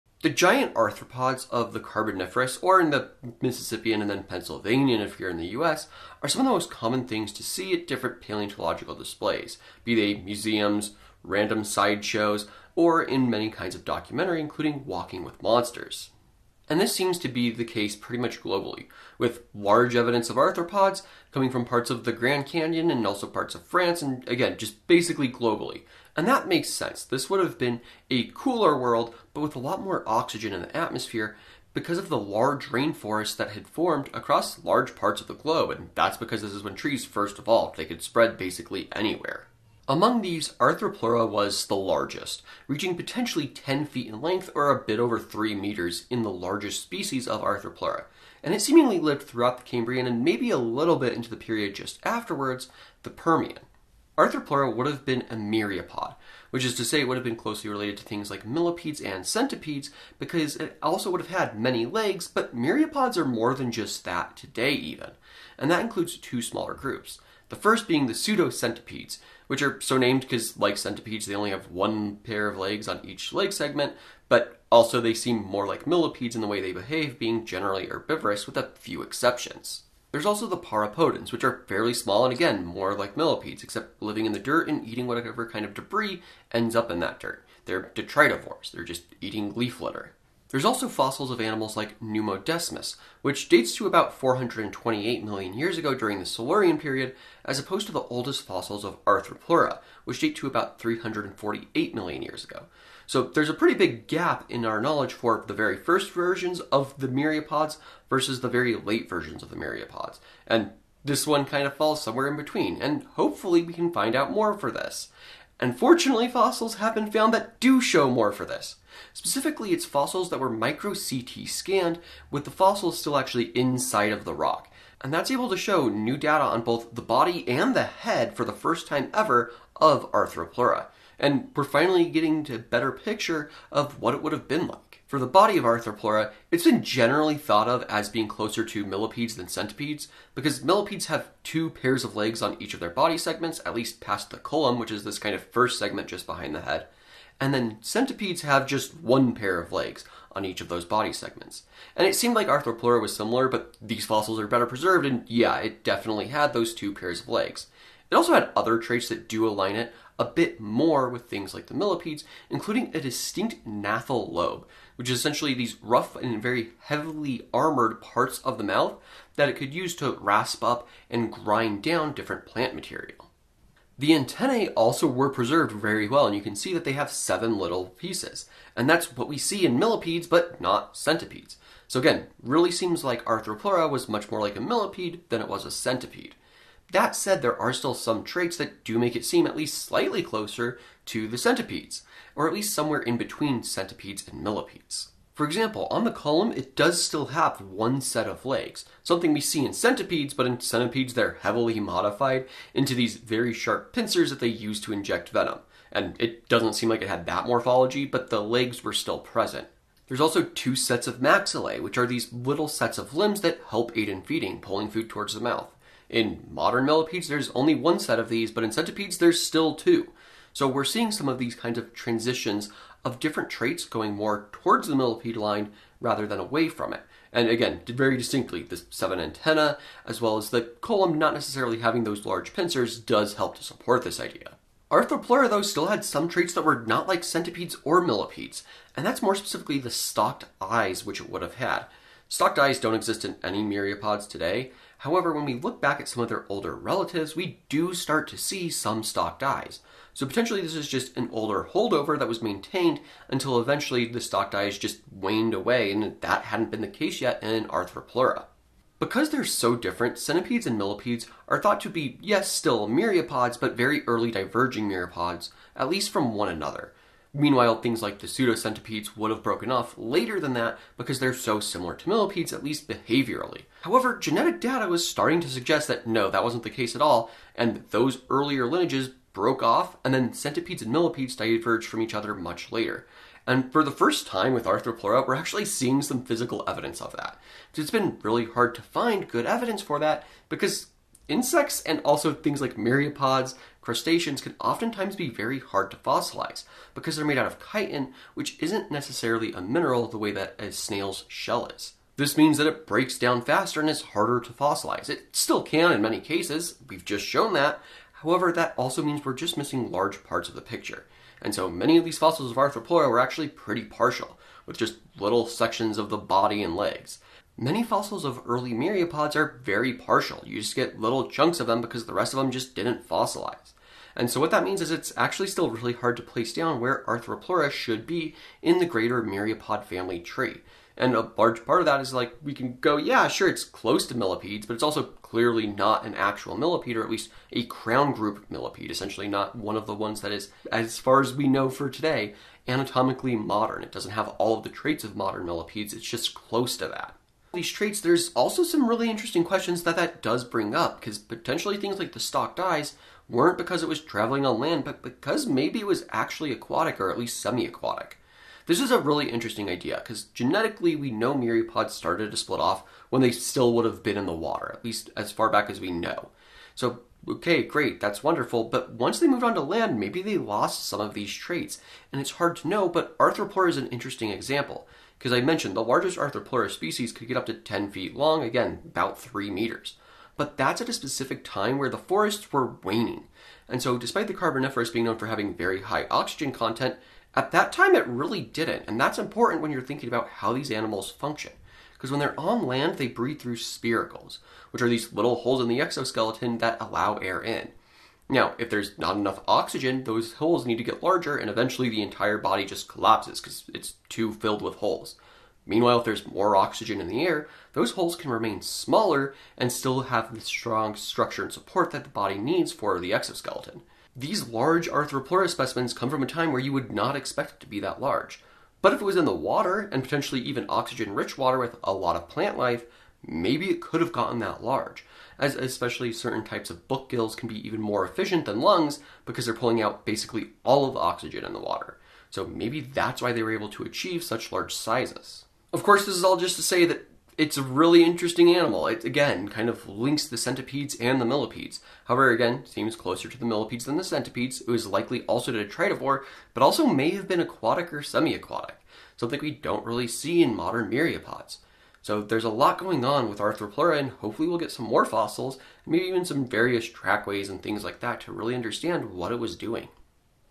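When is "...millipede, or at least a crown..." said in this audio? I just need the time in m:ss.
5:36.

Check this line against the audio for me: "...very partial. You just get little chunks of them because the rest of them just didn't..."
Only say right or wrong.
right.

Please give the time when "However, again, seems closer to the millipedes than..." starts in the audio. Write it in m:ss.
7:22.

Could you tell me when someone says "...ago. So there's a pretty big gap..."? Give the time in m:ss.
1:42.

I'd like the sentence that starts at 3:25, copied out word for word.
And it doesn't seem like it had that morphology, but the legs were still present.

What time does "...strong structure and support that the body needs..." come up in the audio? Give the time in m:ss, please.
6:50.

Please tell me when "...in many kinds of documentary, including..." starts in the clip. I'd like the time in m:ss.
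0:13.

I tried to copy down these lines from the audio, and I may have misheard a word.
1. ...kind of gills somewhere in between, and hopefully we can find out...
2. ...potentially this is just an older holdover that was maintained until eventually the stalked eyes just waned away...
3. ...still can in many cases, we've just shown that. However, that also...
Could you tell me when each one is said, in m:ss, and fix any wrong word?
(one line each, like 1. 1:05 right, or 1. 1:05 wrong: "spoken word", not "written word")
1. 1:51 wrong: "falls", not "gills"
2. 4:10 right
3. 5:05 right.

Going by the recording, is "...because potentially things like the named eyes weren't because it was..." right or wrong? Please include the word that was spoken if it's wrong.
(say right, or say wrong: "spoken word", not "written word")
wrong: "stalked", not "named".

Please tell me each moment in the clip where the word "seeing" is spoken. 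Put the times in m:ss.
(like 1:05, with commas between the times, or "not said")
3:40, 4:45.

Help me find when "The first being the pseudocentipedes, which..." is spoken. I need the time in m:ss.
1:07.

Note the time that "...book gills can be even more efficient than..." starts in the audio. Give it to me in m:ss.
7:06.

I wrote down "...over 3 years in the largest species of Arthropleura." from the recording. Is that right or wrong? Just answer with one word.
wrong.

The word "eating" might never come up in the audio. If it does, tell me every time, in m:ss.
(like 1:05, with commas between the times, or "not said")
1:24, 1:29.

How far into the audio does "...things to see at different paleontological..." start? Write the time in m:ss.
0:07.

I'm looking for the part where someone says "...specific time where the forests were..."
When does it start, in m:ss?
6:20.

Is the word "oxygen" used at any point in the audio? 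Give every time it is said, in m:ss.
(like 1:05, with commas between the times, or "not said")
0:30, 6:26, 6:39, 6:46, 7:00, 7:10.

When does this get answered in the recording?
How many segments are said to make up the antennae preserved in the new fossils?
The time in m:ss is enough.
2:57.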